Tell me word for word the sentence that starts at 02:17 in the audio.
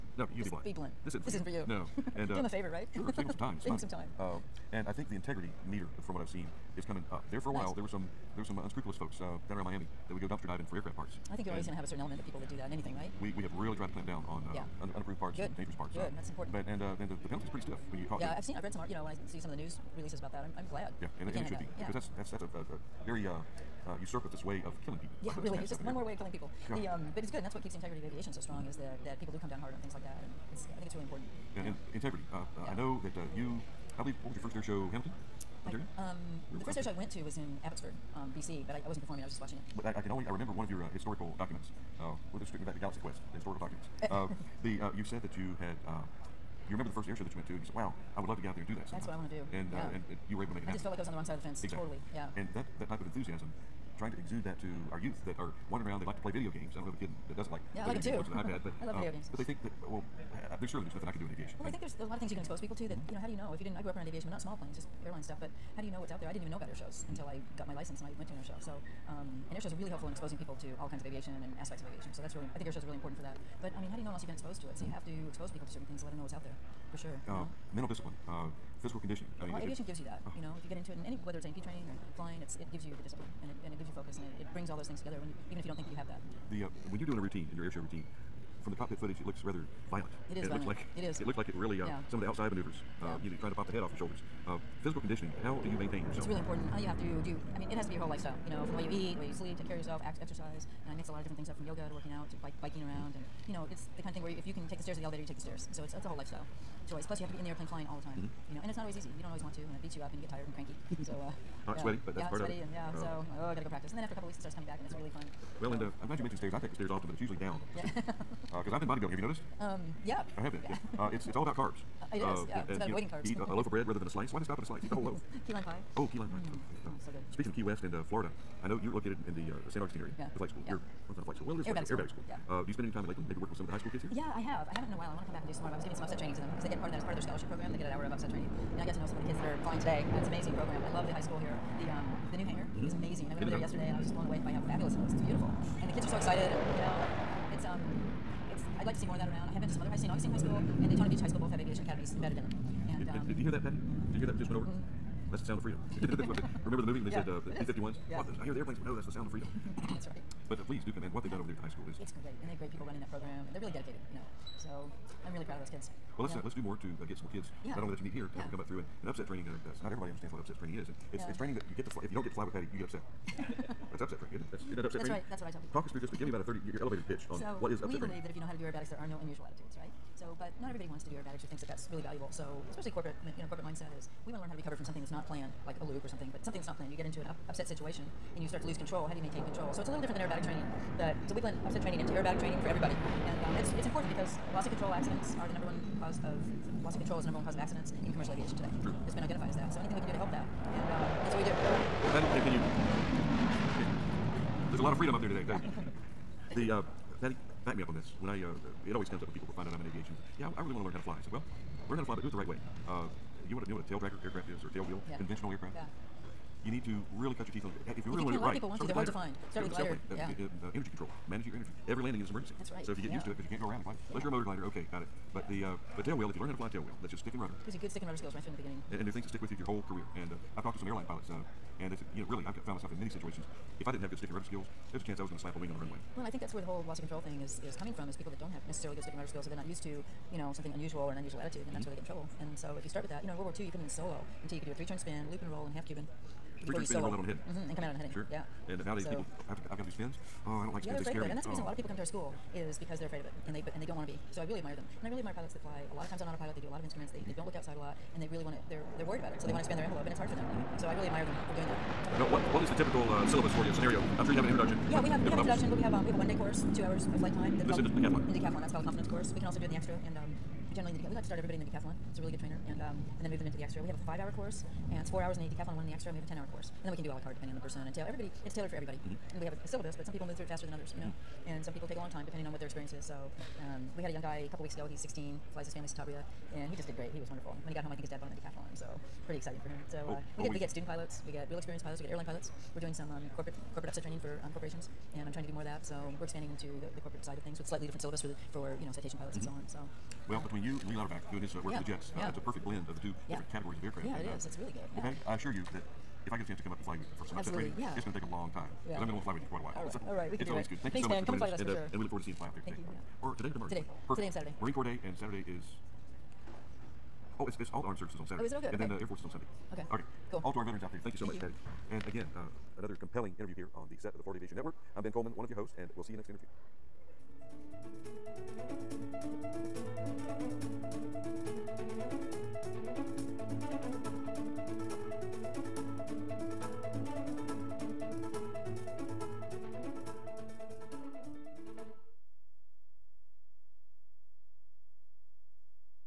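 They get an hour of upset training, and I got to know some of the kids that are flying today.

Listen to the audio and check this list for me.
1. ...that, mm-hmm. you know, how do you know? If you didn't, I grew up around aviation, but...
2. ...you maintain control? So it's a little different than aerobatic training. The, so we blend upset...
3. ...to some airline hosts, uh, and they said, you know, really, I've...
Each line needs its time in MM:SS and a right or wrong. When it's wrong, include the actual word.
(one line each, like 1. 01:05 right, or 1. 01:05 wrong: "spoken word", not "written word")
1. 01:02 right
2. 03:09 right
3. 03:50 wrong: "pilots", not "hosts".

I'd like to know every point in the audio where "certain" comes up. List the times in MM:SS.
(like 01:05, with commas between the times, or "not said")
00:11, 01:15.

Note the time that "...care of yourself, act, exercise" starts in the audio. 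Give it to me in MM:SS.
01:39.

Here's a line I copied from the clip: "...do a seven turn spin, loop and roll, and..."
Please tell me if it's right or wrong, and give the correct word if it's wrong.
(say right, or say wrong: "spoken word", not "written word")
wrong: "three", not "seven".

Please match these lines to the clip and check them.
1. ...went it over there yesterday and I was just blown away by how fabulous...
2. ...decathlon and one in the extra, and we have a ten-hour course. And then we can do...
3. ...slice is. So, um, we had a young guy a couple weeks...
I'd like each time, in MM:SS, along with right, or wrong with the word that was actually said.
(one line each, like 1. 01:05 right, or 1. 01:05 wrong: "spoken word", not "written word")
1. 02:23 right
2. 04:35 right
3. 04:42 wrong: "experience", not "slice".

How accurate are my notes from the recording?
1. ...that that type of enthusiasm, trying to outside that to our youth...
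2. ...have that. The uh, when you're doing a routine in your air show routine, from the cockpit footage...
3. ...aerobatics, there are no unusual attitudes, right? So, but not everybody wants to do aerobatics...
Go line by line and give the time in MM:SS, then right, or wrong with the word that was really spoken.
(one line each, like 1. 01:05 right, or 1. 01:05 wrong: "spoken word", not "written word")
1. 00:52 wrong: "exude", not "outside"
2. 01:25 right
3. 02:58 right.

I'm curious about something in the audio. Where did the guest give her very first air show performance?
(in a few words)
Hamilton, Ontario.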